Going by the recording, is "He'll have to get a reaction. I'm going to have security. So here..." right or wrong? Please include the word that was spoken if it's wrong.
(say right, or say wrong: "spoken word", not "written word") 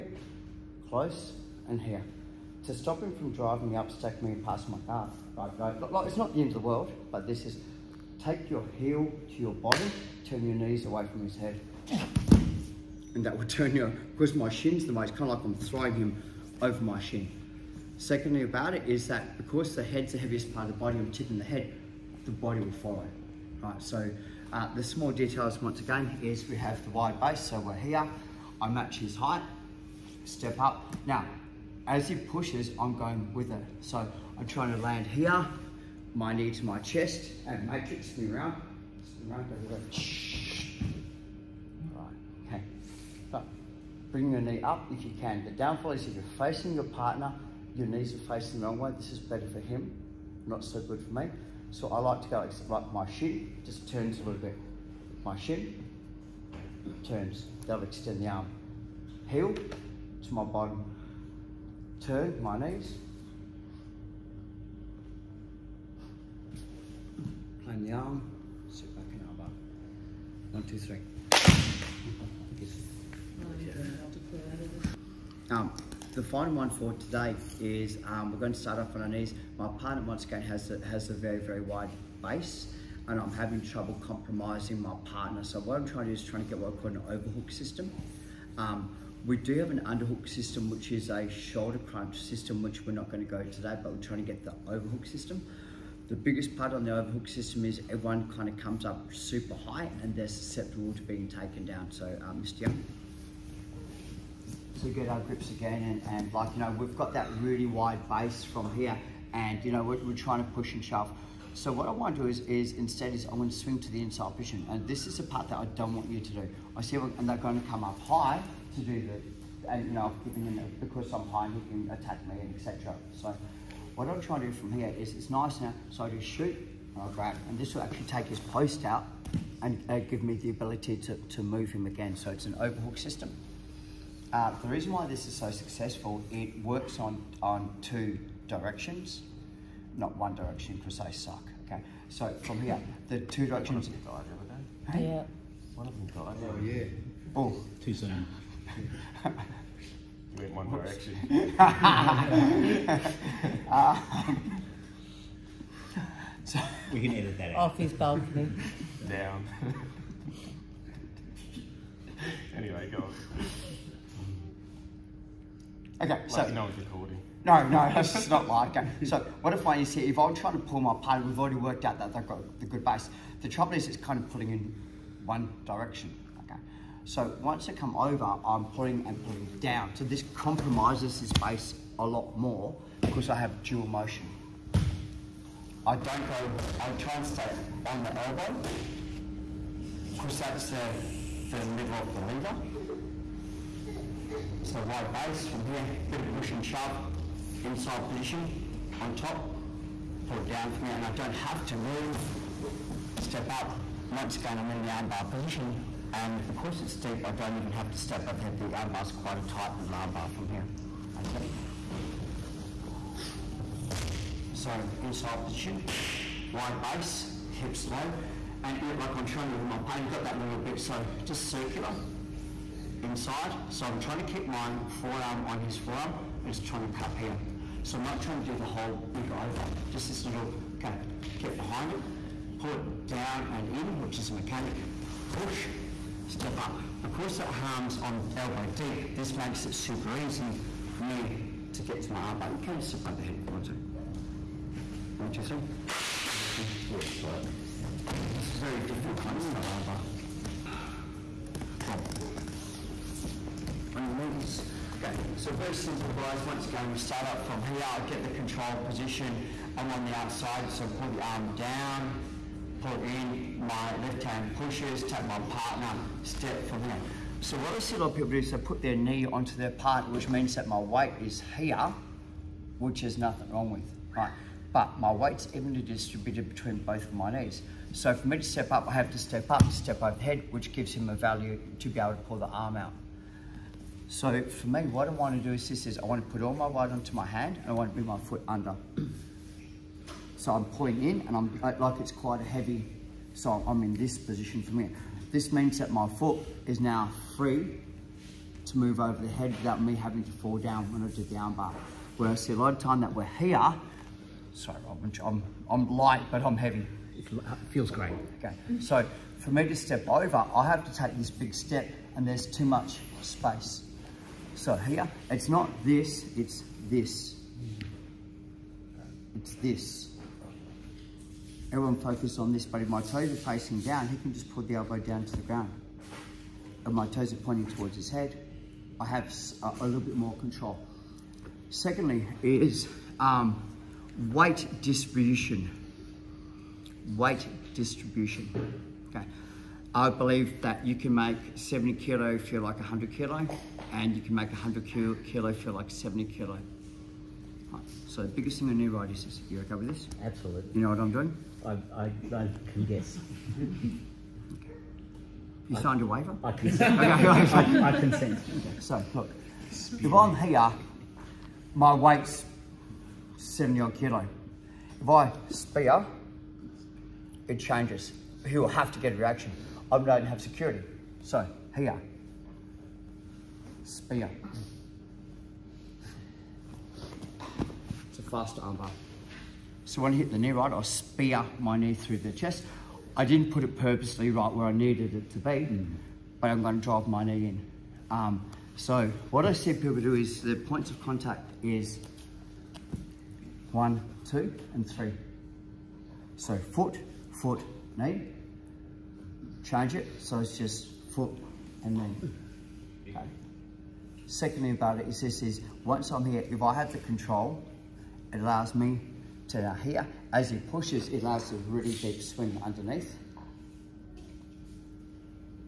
right.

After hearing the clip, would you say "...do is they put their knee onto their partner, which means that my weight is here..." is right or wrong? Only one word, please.
right.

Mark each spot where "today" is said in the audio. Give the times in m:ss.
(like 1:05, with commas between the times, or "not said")
1:16, 1:33.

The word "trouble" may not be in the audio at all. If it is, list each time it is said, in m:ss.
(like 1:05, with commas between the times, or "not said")
1:23, 2:53.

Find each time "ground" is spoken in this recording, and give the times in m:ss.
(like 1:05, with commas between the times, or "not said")
5:25.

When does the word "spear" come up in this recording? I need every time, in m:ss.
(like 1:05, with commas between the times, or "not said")
6:05, 6:13, 6:20.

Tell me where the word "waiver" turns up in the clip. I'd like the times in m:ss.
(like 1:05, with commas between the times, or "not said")
5:56.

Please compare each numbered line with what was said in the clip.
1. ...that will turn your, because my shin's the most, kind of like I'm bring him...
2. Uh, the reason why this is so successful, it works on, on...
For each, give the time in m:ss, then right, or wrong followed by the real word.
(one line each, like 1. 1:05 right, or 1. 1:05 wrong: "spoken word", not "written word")
1. 0:13 wrong: "throwing", not "bring"
2. 2:14 right.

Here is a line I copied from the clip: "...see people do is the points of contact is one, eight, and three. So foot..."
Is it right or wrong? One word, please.
wrong.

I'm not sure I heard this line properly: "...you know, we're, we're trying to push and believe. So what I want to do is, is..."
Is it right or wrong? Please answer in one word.
wrong.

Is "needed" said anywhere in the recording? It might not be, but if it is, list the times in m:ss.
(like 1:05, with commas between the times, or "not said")
6:24.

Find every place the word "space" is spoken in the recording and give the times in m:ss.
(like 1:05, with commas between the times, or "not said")
5:13.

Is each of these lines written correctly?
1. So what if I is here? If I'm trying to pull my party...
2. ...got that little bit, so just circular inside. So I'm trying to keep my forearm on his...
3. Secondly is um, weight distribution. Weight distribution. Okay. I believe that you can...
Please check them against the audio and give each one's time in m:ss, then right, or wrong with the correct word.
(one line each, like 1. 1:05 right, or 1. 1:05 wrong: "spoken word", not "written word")
1. 2:49 right
2. 3:40 right
3. 5:31 right.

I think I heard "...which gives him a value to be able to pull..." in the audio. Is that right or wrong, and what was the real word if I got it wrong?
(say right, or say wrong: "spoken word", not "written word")
right.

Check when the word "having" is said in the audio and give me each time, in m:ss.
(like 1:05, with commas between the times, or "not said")
1:23, 4:59.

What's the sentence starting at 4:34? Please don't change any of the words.
But my weight's evenly distributed between both of my knees.